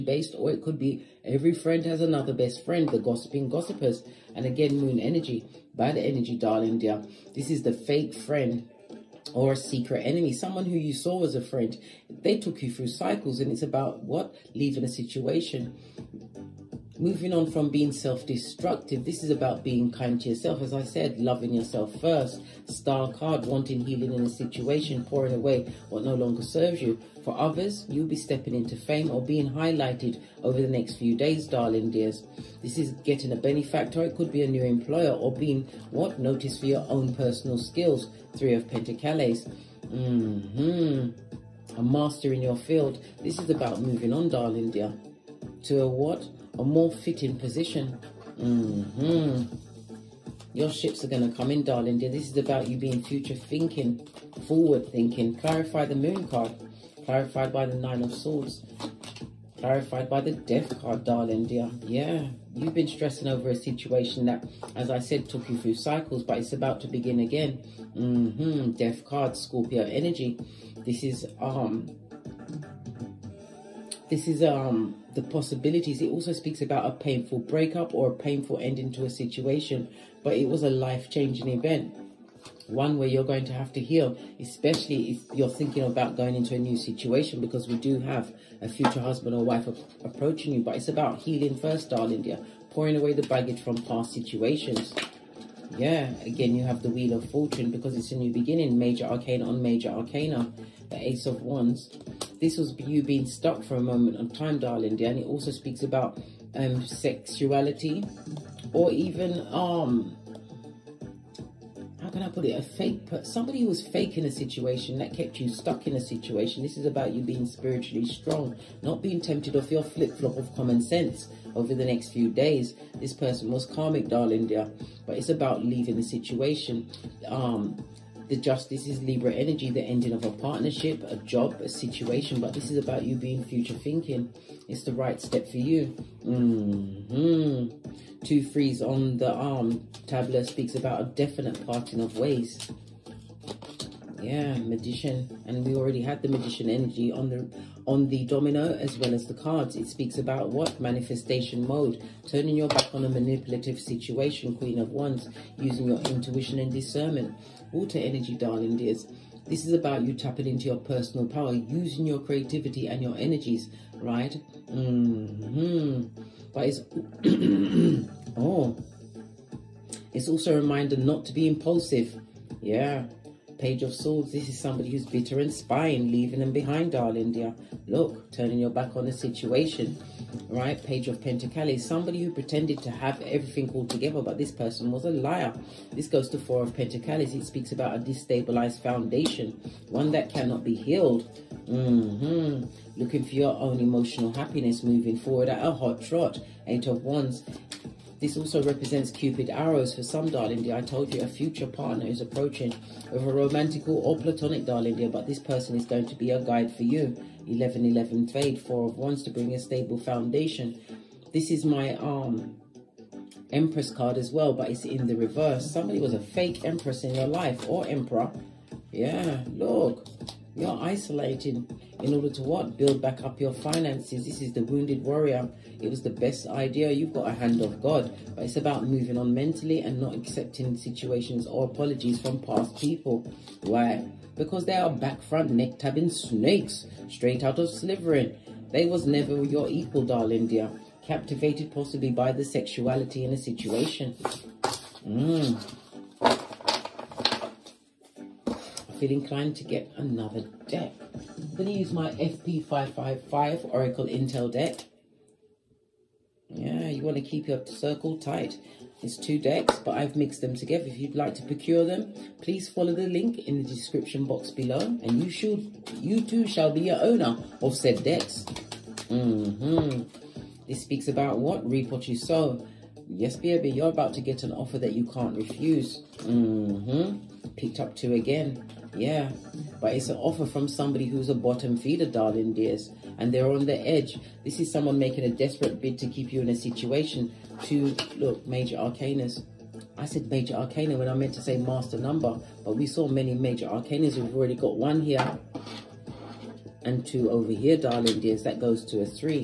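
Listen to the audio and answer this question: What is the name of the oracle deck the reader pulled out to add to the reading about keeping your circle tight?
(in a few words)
FP555 Oracle Intel deck.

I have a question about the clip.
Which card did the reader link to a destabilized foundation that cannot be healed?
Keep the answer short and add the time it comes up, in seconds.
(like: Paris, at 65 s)
Four of Pentacles, at 186 s.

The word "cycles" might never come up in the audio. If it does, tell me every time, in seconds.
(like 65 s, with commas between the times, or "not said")
12 s, 65 s.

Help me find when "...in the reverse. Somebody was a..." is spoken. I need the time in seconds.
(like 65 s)
214 s.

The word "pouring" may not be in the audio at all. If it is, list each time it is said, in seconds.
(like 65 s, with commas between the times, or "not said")
25 s, 92 s.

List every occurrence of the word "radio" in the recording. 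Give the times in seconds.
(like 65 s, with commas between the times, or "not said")
not said.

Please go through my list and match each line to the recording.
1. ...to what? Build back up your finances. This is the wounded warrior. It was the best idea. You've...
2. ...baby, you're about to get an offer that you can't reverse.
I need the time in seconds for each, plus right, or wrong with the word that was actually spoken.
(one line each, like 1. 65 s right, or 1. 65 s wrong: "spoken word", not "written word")
1. 222 s right
2. 273 s wrong: "refuse", not "reverse".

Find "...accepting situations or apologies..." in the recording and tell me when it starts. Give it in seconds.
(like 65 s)
230 s.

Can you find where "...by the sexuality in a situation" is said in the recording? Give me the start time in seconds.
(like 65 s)
242 s.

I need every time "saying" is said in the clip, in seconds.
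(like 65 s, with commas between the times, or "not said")
not said.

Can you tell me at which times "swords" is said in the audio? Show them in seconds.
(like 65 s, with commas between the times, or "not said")
58 s, 173 s.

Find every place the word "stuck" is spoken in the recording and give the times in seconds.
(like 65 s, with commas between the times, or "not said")
103 s, 115 s.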